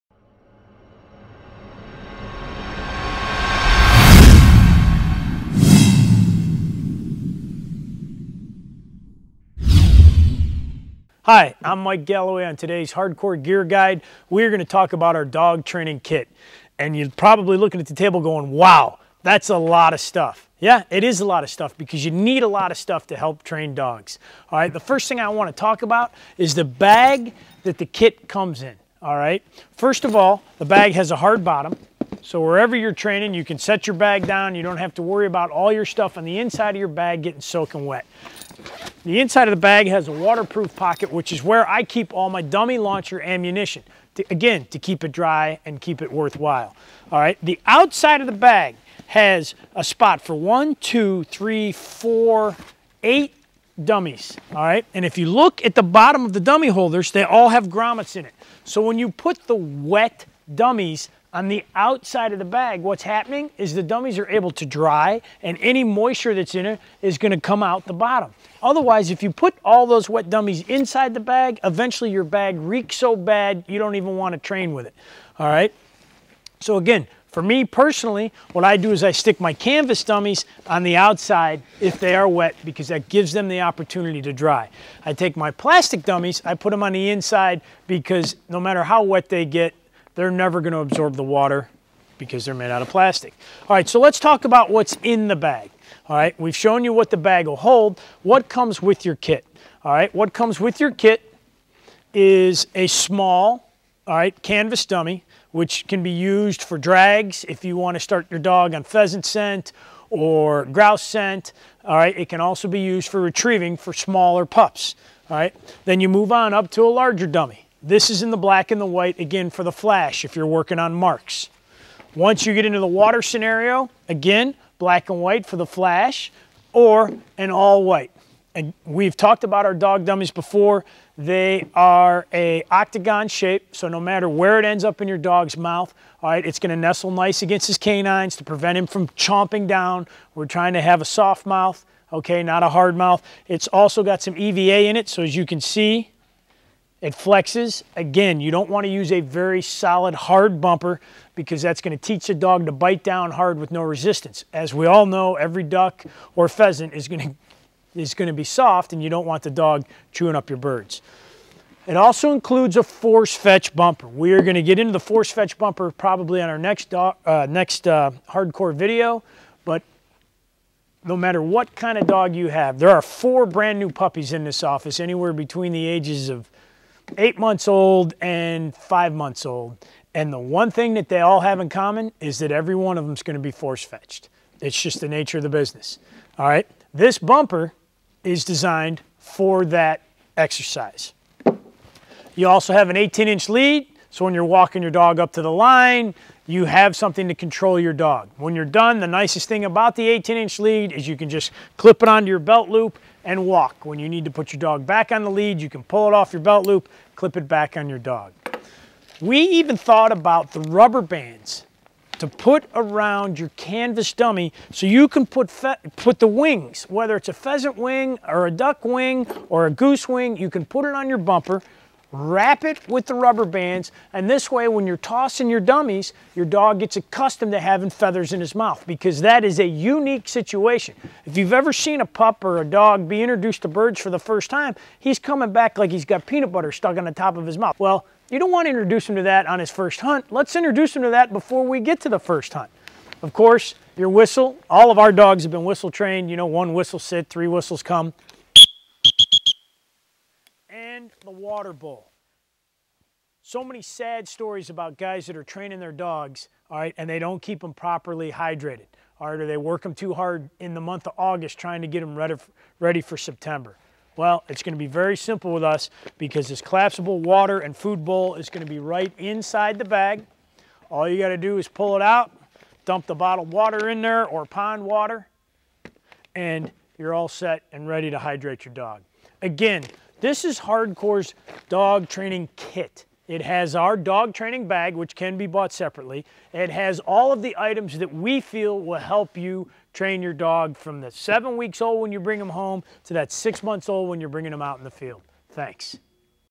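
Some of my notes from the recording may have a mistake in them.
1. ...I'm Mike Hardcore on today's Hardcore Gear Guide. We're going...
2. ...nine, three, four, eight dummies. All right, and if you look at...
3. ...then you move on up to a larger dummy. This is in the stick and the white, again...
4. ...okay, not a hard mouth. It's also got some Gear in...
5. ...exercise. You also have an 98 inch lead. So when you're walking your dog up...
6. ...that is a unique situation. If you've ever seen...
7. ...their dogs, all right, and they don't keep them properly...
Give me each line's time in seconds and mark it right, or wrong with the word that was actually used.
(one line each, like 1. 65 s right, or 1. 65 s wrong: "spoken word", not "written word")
1. 11 s wrong: "Galloway", not "Hardcore"
2. 50 s wrong: "two", not "nine"
3. 115 s wrong: "black", not "stick"
4. 142 s wrong: "EVA", not "Gear"
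5. 190 s wrong: "18", not "98"
6. 229 s right
7. 255 s right.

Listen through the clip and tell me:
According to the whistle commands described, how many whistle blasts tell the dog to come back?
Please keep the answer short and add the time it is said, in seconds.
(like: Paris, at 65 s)
3, at 247 s.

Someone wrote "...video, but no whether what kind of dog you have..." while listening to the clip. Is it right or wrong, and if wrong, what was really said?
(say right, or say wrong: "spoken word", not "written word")
wrong: "matter", not "whether".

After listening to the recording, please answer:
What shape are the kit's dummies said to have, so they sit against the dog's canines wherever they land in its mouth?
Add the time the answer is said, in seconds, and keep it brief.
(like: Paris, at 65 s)
Octagon, at 132 s.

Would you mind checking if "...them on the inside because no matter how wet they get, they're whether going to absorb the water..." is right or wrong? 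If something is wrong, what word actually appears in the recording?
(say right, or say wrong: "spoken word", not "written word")
wrong: "never", not "whether".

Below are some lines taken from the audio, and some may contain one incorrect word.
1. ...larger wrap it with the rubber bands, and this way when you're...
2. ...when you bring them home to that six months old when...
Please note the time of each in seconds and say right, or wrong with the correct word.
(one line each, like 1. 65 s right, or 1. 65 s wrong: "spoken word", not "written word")
1. 221 s wrong: "bumper", not "larger"
2. 292 s right.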